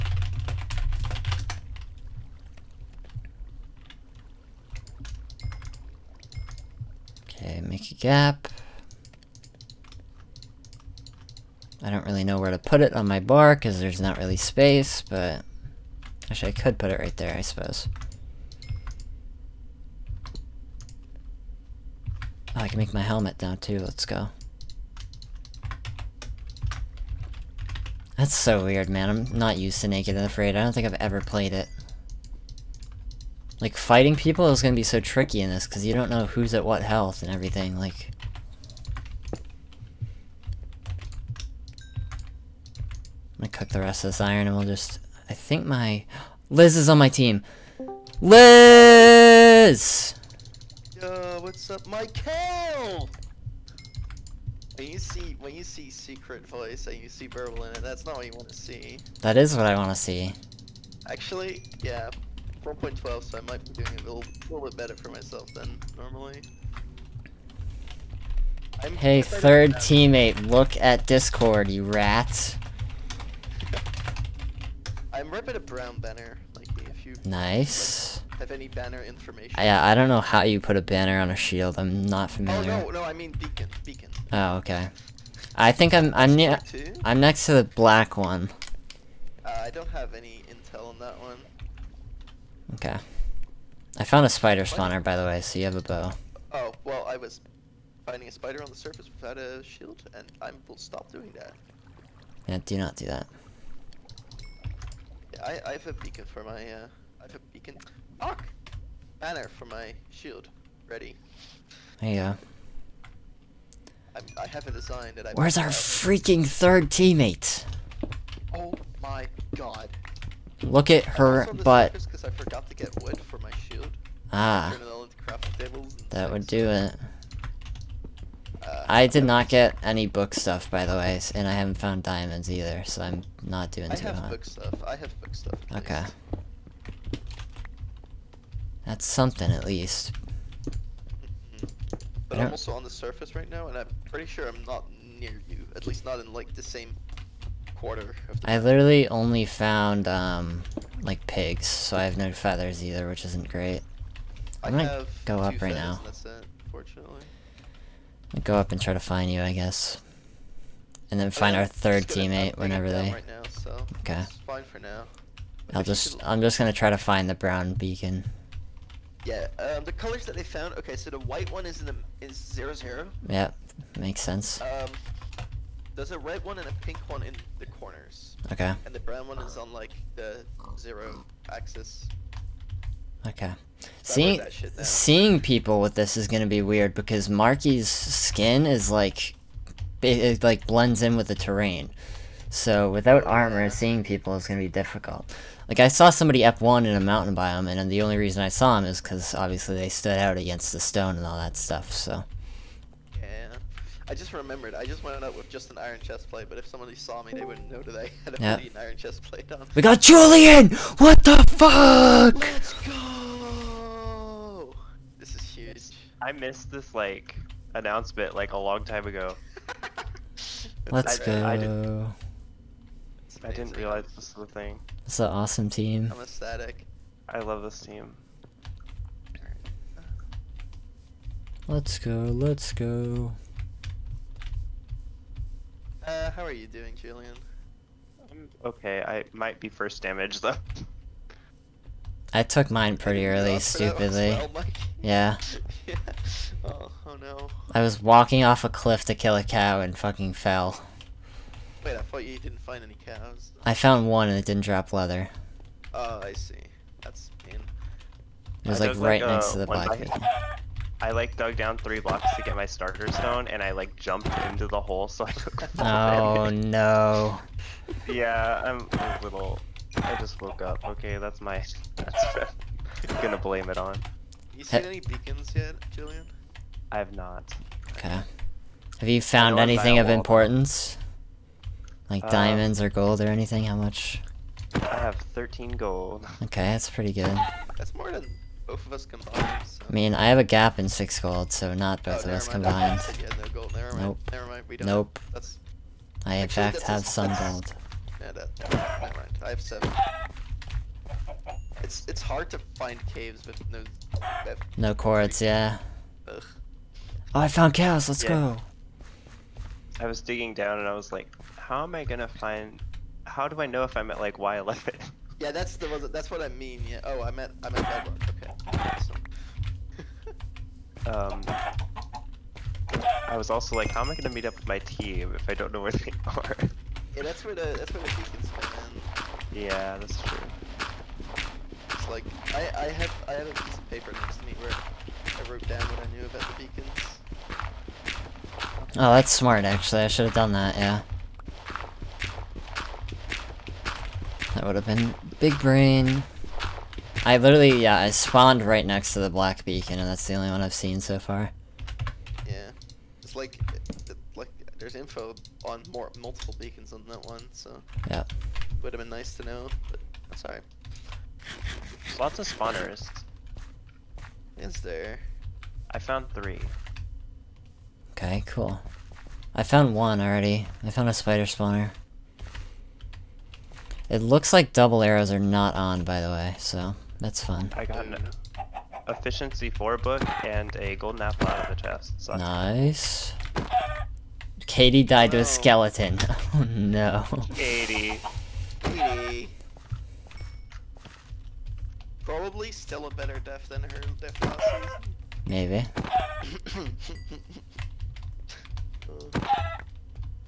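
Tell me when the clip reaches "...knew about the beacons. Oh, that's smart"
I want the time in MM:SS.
05:36.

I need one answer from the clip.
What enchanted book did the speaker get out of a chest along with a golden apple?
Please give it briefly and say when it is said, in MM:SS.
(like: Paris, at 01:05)
Efficiency 4, at 06:19.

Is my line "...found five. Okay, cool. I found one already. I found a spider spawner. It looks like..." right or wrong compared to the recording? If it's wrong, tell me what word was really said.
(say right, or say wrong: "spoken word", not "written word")
wrong: "three", not "five".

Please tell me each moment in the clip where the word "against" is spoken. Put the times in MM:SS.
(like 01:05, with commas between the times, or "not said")
03:20.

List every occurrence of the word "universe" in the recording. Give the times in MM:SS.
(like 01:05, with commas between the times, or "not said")
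not said.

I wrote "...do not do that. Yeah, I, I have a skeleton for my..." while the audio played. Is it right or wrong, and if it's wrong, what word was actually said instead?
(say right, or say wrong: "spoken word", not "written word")
wrong: "beacon", not "skeleton".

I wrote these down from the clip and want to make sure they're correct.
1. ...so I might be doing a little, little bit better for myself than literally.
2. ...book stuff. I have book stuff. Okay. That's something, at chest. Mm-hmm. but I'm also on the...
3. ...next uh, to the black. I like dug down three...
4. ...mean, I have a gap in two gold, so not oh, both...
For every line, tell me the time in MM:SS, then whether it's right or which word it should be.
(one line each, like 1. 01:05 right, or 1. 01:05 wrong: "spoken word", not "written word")
1. 01:03 wrong: "normally", not "literally"
2. 02:14 wrong: "least", not "chest"
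3. 04:19 right
4. 04:49 wrong: "six", not "two".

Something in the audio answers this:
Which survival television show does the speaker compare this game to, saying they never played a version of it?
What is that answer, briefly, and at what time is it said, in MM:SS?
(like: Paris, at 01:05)
Naked and Afraid, at 00:29.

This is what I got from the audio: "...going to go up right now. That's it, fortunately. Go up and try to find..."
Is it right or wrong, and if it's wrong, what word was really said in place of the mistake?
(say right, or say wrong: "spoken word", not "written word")
right.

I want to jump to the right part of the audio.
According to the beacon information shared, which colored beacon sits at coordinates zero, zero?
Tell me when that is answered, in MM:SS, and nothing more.
02:51.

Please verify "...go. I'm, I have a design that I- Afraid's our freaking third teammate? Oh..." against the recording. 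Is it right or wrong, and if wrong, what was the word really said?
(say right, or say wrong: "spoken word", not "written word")
wrong: "Where", not "Afraid".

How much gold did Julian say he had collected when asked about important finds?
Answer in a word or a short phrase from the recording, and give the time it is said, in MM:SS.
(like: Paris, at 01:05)
13, at 04:45.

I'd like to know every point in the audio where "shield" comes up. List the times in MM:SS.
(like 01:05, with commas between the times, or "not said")
01:21, 01:39, 01:50.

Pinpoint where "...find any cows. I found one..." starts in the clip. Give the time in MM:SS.
04:12.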